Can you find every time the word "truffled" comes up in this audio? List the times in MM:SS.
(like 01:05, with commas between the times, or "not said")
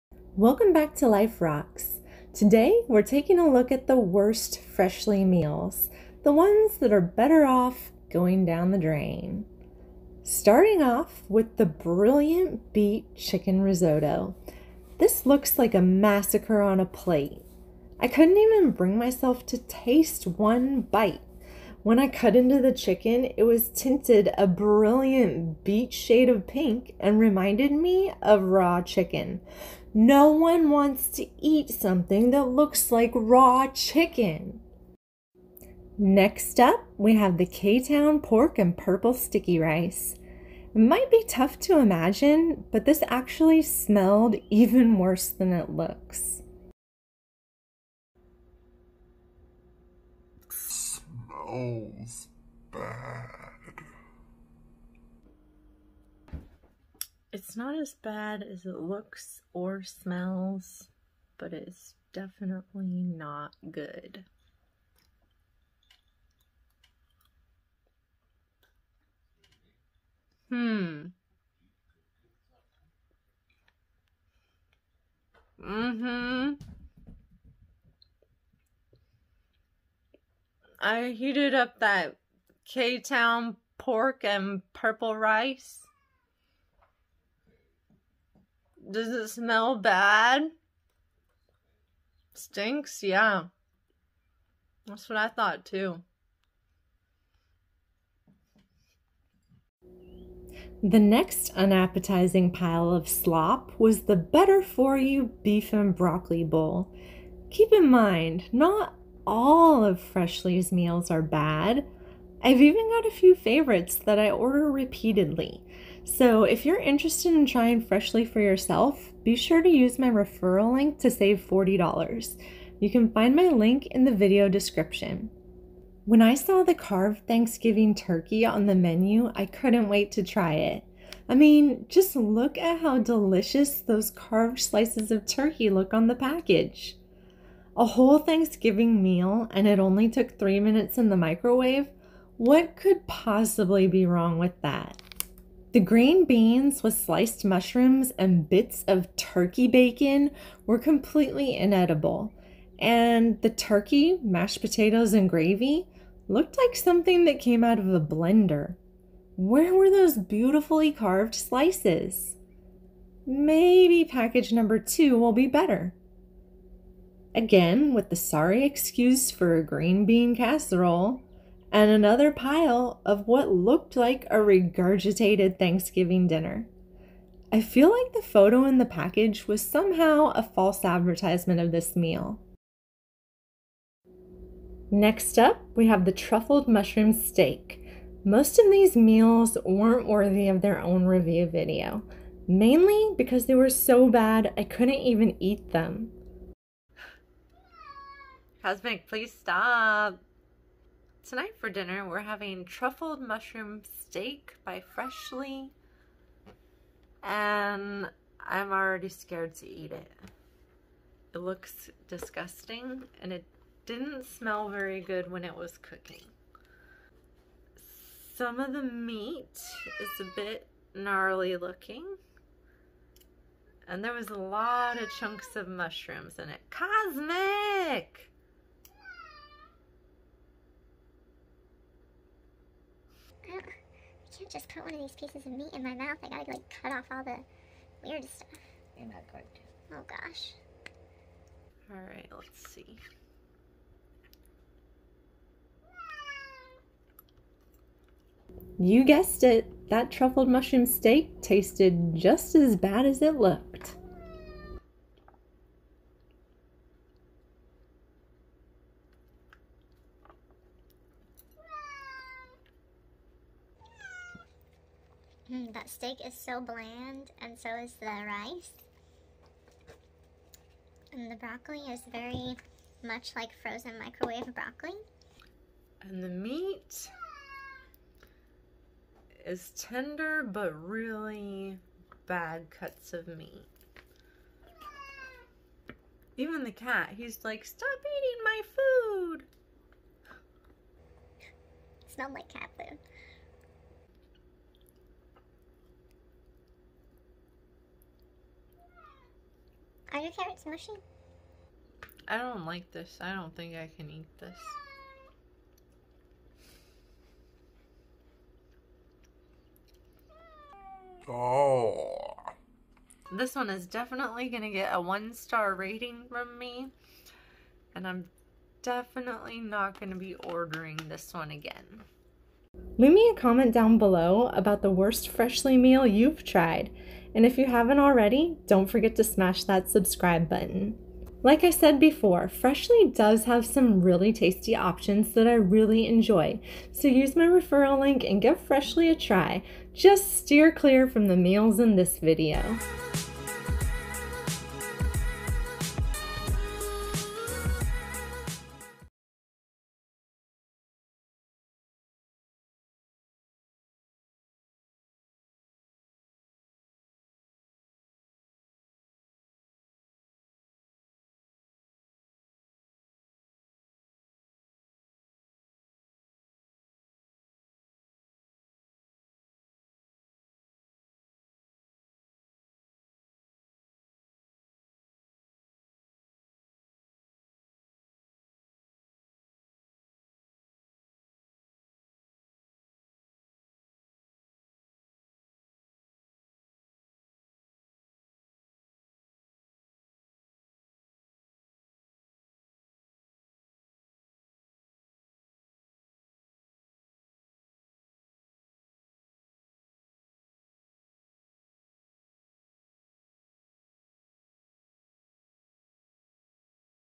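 03:06, 03:22, 04:10.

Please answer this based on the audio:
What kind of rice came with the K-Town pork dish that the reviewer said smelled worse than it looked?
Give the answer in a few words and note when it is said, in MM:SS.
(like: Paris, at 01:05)
Purple sticky rice, at 00:38.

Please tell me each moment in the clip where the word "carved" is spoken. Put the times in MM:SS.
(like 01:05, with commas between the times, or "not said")
02:06, 02:14, 02:40.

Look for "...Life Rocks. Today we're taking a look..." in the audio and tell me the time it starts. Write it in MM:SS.
00:01.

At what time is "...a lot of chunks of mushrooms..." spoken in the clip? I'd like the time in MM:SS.
03:44.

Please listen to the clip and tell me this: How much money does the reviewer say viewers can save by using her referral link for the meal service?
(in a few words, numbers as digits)
$40.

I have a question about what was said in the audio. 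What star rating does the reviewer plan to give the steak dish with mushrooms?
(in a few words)
1 star.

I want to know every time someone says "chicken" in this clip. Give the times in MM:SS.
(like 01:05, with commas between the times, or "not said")
00:13, 00:22, 00:28, 00:33.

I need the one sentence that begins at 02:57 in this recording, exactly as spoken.
I feel like the photo in the package was somehow a false advertisement of this meal.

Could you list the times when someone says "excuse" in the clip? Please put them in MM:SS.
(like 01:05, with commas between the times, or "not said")
02:48.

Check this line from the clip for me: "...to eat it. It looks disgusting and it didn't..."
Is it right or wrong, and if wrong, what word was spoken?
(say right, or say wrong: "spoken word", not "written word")
right.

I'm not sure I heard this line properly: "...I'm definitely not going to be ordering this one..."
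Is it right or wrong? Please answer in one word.
right.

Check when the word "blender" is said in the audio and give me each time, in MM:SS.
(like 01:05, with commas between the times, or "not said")
02:38.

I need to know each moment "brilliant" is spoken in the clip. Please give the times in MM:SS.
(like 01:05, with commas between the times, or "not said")
00:11, 00:24.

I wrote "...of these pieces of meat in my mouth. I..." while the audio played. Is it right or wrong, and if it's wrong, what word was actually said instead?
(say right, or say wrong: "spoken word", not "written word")
right.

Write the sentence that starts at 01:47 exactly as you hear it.
Keep in mind, not all of Freshly's meals are bad.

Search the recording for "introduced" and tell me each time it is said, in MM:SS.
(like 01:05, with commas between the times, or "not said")
not said.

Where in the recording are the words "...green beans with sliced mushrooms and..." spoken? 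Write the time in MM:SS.
02:25.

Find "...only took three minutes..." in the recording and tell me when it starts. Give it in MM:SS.
02:19.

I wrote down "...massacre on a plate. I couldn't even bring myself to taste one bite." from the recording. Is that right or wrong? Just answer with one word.
right.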